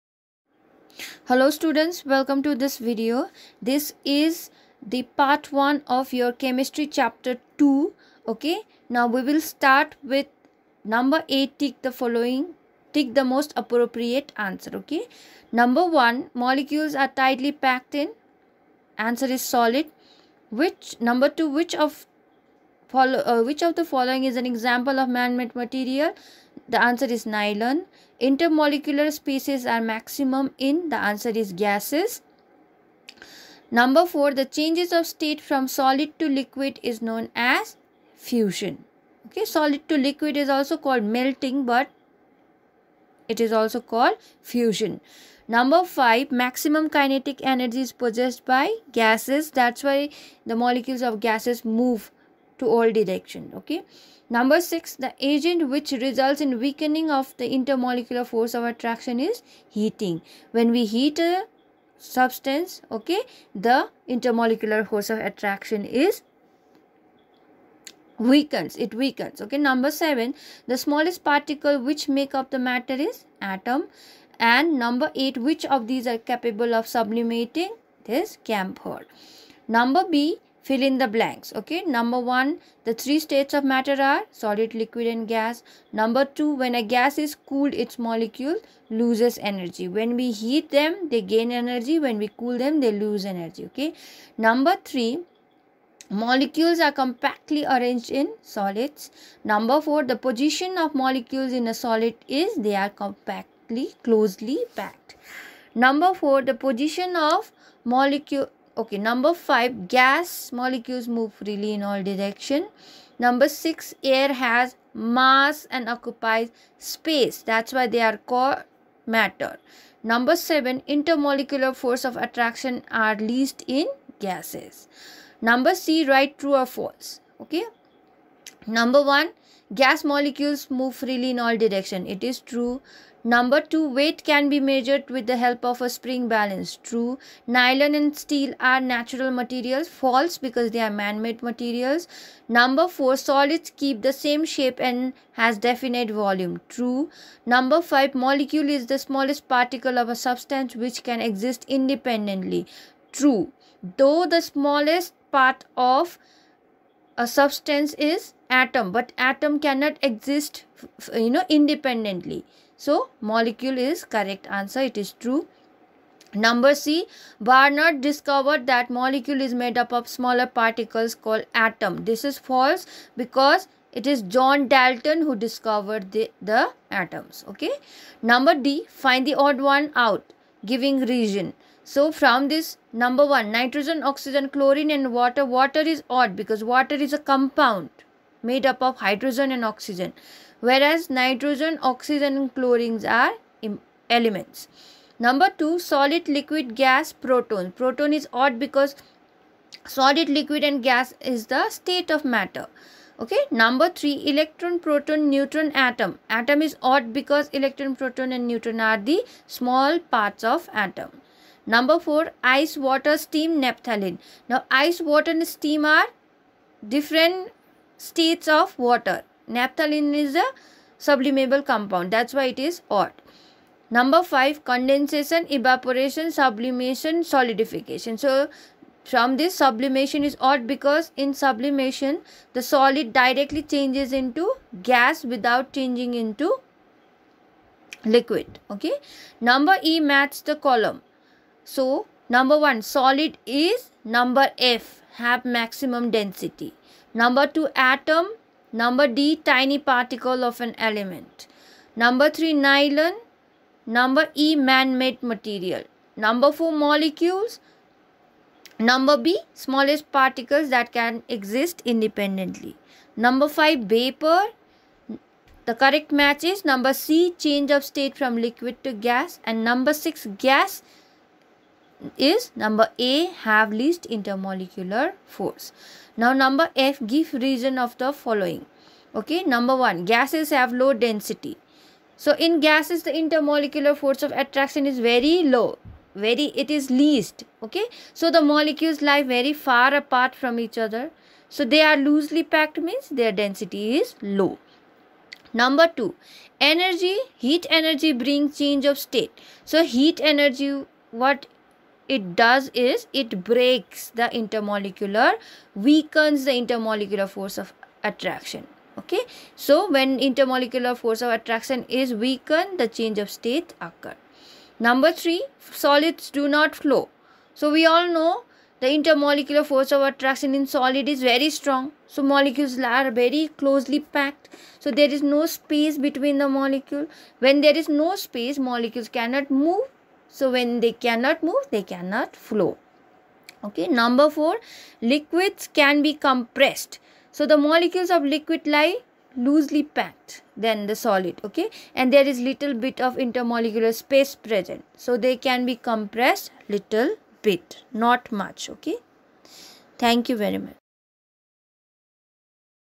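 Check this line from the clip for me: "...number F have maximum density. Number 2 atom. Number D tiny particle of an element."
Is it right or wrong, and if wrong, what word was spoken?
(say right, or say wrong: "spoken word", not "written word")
right.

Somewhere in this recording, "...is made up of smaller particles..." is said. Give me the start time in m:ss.
2:49.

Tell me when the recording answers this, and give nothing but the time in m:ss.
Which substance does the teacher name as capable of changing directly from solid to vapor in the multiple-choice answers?
1:18.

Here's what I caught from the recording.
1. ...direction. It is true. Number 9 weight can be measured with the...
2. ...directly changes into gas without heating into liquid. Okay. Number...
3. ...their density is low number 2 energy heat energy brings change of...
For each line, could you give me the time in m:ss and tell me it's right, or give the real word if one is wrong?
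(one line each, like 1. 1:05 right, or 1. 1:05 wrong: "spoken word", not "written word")
1. 2:11 wrong: "2", not "9"
2. 3:53 wrong: "changing", not "heating"
3. 4:53 right.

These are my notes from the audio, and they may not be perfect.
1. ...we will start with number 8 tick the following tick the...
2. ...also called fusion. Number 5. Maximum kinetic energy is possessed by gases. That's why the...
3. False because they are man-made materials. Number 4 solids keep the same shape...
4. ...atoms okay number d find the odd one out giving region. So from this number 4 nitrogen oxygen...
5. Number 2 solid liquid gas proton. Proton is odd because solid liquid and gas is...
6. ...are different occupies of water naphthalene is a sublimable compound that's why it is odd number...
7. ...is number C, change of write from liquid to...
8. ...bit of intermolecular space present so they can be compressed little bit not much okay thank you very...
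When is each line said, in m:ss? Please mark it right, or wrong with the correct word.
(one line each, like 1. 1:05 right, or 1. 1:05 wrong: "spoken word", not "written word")
1. 0:09 right
2. 0:43 right
3. 2:19 right
4. 2:57 wrong: "1", not "4"
5. 3:15 right
6. 3:35 wrong: "states", not "occupies"
7. 4:26 wrong: "state", not "write"
8. 5:42 right.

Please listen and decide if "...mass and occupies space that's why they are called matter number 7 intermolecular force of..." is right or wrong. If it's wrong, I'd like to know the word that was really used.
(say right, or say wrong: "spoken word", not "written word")
right.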